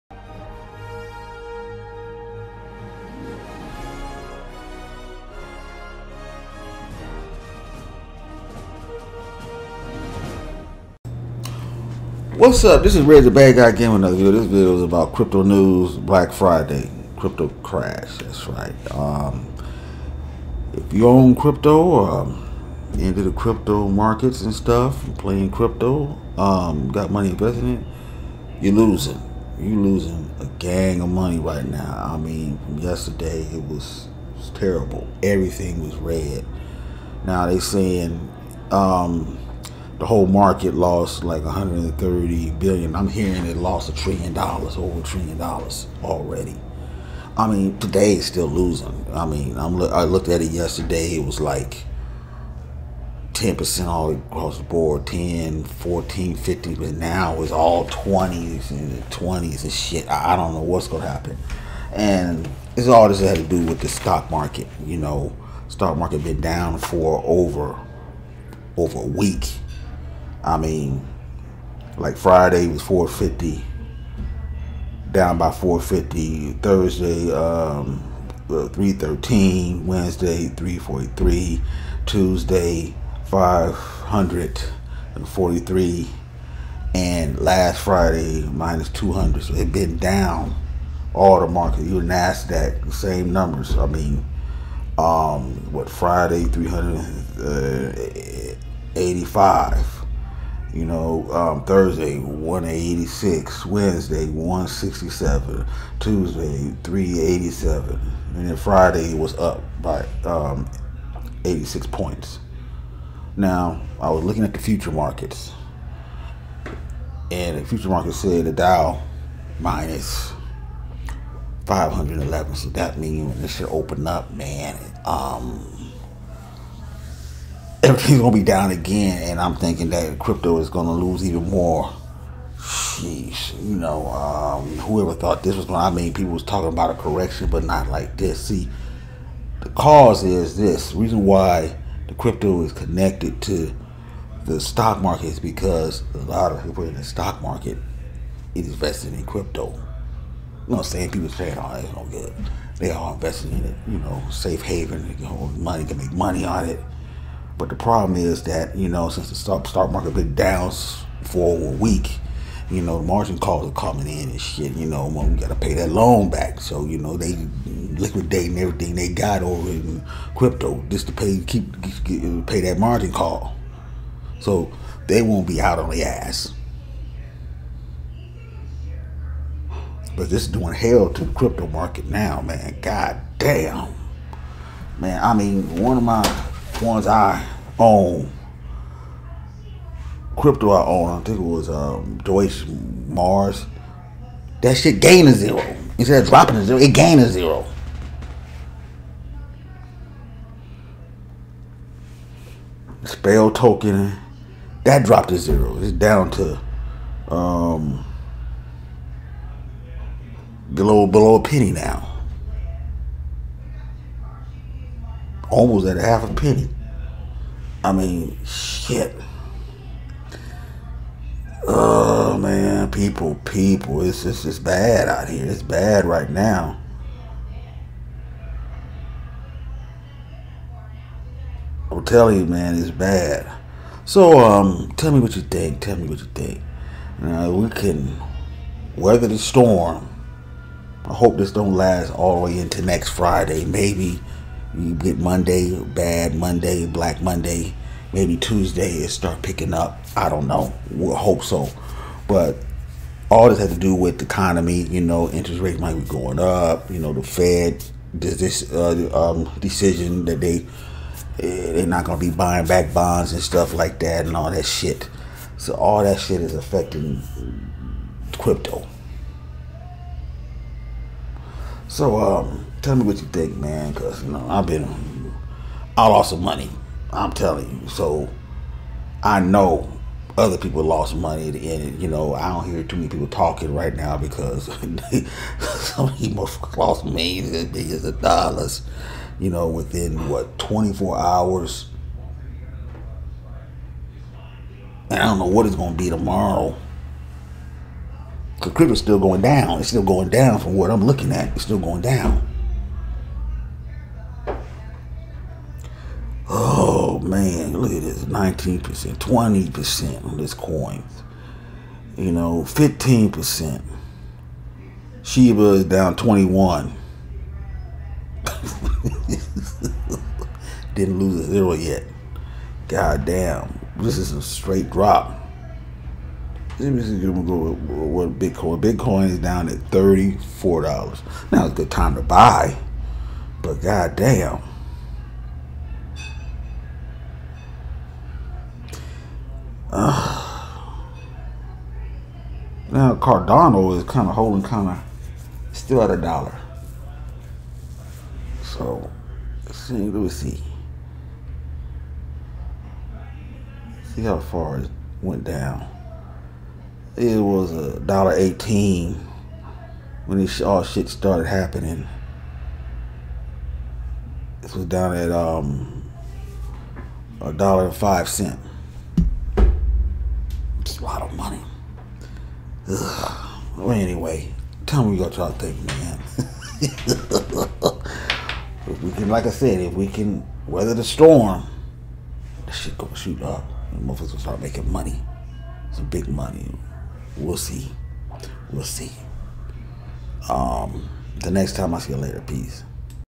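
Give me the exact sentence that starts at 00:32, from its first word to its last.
I mean, from yesterday, it was, it was terrible.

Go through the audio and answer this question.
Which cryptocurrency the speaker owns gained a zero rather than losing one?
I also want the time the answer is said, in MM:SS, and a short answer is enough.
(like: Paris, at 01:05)
Deutsche Mars, at 03:12.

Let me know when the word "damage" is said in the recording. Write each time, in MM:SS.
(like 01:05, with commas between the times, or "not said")
not said.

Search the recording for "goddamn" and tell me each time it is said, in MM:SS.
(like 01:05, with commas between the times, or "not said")
05:33.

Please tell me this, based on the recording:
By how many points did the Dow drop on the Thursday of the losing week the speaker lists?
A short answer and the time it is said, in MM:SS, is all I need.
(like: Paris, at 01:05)
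313, at 01:18.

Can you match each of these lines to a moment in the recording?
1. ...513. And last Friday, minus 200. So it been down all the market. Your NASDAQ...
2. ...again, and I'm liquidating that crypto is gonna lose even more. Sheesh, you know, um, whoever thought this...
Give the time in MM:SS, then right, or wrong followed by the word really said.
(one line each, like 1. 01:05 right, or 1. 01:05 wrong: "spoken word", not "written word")
1. 01:23 wrong: "543", not "513"
2. 02:08 wrong: "thinking", not "liquidating".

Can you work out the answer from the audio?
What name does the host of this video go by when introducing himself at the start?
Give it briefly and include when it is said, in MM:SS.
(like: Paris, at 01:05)
REG the Bad Guy Game, at 00:13.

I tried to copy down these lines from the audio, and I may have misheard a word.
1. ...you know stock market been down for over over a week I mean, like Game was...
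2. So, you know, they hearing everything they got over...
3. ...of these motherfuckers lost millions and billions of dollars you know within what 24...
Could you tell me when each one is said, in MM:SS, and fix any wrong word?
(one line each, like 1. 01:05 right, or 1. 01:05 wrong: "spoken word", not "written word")
1. 01:04 wrong: "Friday", not "Game"
2. 02:46 wrong: "liquidating", not "hearing"
3. 04:46 right.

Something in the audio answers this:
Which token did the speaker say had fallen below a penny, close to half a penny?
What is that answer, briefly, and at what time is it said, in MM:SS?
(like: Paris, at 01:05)
Spell token, at 03:23.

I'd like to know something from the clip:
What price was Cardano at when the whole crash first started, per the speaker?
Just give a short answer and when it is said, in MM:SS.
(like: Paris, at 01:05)
$1.18, at 05:57.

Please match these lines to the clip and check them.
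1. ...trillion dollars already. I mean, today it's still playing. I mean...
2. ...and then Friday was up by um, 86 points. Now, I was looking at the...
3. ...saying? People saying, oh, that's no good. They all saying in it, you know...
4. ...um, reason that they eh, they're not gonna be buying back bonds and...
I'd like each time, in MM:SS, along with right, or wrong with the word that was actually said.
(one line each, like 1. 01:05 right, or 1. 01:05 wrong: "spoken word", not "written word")
1. 00:45 wrong: "losing", not "playing"
2. 01:48 right
3. 02:30 wrong: "investing", not "saying"
4. 04:19 wrong: "decision", not "reason".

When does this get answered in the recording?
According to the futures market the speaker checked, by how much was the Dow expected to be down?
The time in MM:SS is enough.
01:59.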